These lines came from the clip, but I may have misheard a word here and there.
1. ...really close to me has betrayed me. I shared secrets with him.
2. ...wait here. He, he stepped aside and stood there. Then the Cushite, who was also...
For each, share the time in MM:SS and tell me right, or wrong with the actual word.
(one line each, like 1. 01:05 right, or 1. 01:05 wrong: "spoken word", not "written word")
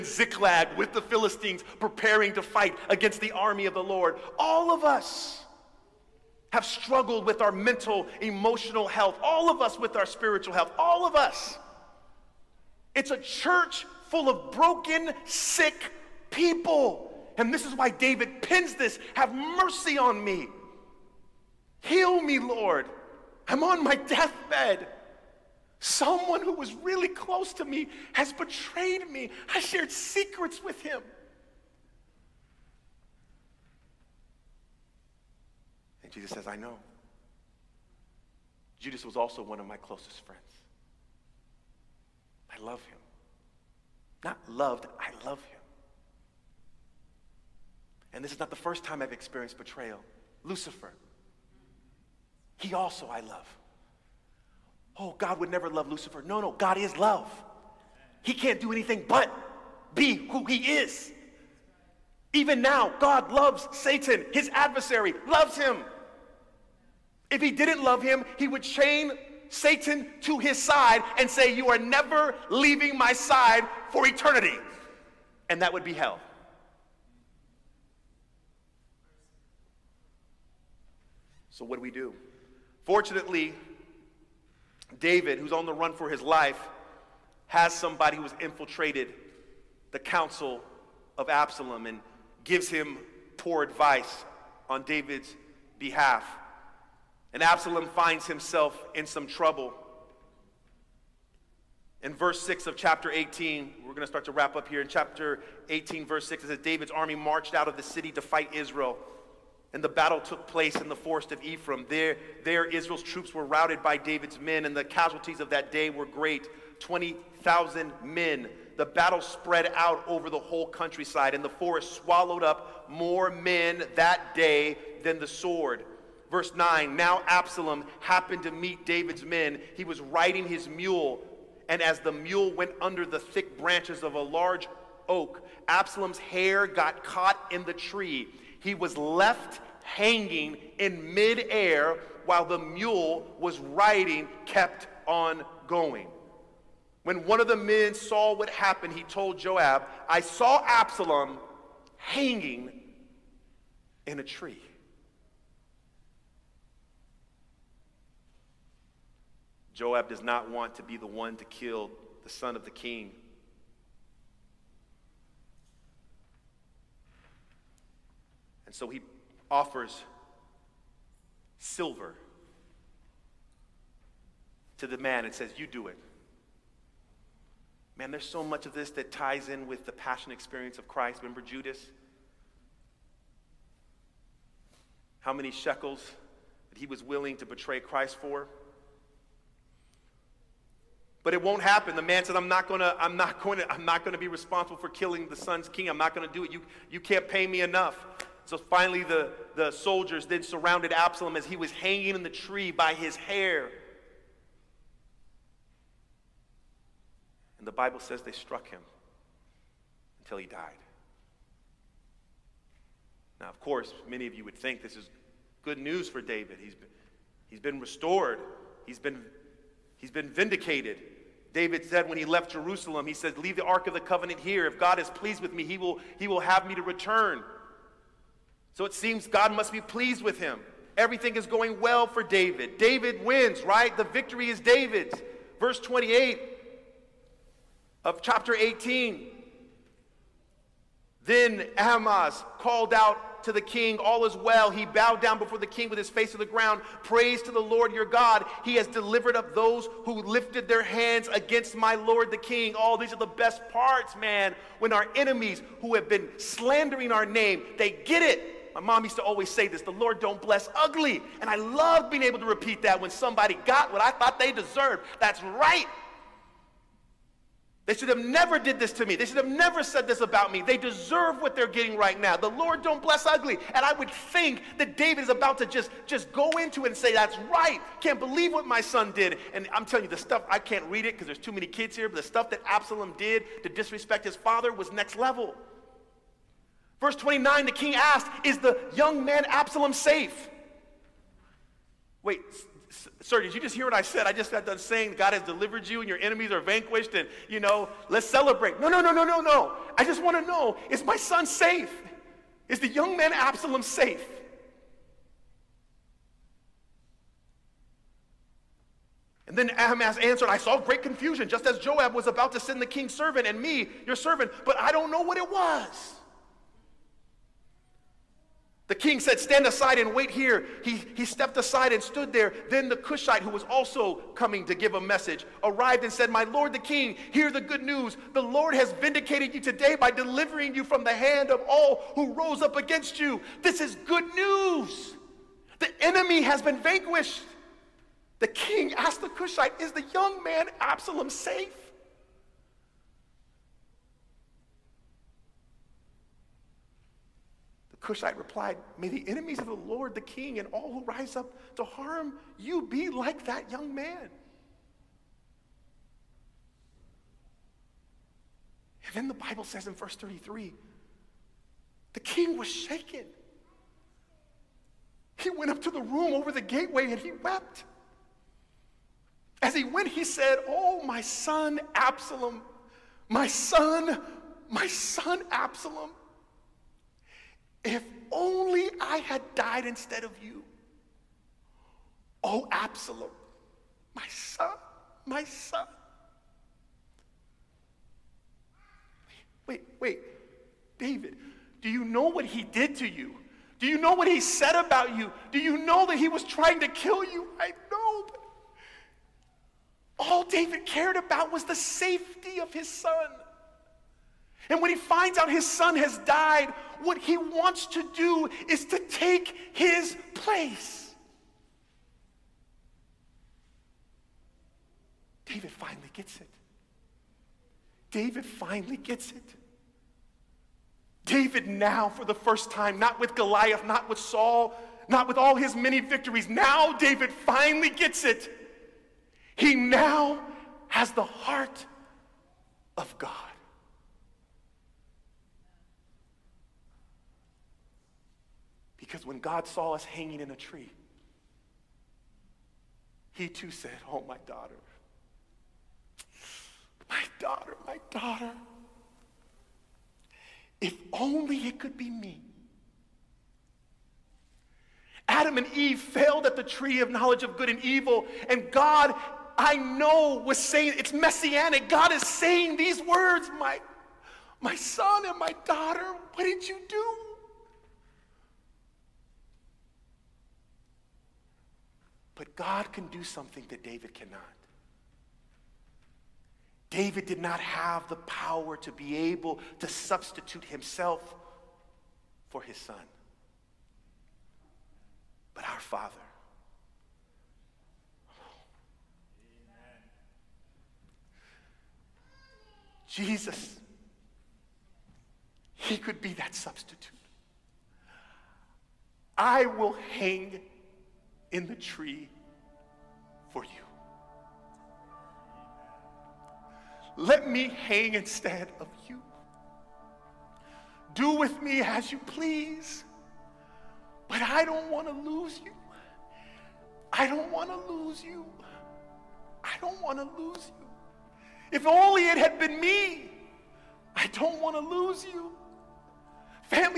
1. 00:26 right
2. 05:20 right.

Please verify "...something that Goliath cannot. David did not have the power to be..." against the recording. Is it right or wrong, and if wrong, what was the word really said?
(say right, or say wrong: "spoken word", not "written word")
wrong: "David", not "Goliath".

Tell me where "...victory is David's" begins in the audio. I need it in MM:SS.
03:54.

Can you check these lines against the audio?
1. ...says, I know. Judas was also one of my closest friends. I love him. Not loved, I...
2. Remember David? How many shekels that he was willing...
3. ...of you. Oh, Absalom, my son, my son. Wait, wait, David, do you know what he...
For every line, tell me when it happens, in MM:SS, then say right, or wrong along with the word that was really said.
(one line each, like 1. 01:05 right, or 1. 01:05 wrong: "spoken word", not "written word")
1. 00:36 right
2. 03:01 wrong: "Judas", not "David"
3. 06:20 right.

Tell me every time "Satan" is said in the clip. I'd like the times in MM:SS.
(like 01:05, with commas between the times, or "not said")
01:03, 01:09.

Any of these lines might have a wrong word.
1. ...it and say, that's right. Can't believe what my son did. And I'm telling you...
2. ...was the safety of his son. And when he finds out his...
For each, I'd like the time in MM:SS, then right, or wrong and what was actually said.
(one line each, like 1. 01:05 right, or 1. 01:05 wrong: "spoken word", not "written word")
1. 04:36 right
2. 06:41 right.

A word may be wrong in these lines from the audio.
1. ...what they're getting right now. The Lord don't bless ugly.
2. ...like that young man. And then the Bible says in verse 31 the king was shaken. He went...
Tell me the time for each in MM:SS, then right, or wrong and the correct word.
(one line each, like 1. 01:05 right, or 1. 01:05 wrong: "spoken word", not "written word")
1. 04:31 right
2. 05:53 wrong: "33", not "31".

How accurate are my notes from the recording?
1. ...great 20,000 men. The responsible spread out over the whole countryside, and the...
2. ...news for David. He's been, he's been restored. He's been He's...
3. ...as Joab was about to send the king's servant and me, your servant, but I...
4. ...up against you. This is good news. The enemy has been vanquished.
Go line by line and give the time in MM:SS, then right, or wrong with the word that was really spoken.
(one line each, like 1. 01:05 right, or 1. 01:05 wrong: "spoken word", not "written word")
1. 01:56 wrong: "battle", not "responsible"
2. 03:35 right
3. 05:11 right
4. 05:32 right.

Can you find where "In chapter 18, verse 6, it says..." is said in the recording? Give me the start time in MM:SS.
01:44.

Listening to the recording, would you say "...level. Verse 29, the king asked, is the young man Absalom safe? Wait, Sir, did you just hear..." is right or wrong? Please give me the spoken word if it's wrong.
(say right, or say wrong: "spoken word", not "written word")
right.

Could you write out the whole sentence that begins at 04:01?
Then Ahimaaz called out to the king, All is well.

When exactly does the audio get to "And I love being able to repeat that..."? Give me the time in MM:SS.
04:21.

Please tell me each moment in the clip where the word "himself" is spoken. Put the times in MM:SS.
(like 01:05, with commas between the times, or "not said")
01:38, 08:00.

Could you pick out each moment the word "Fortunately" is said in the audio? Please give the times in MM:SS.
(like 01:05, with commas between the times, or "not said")
01:22.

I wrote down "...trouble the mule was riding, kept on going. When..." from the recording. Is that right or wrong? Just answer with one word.
wrong.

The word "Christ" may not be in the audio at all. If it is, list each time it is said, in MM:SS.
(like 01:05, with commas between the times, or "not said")
03:00, 03:07.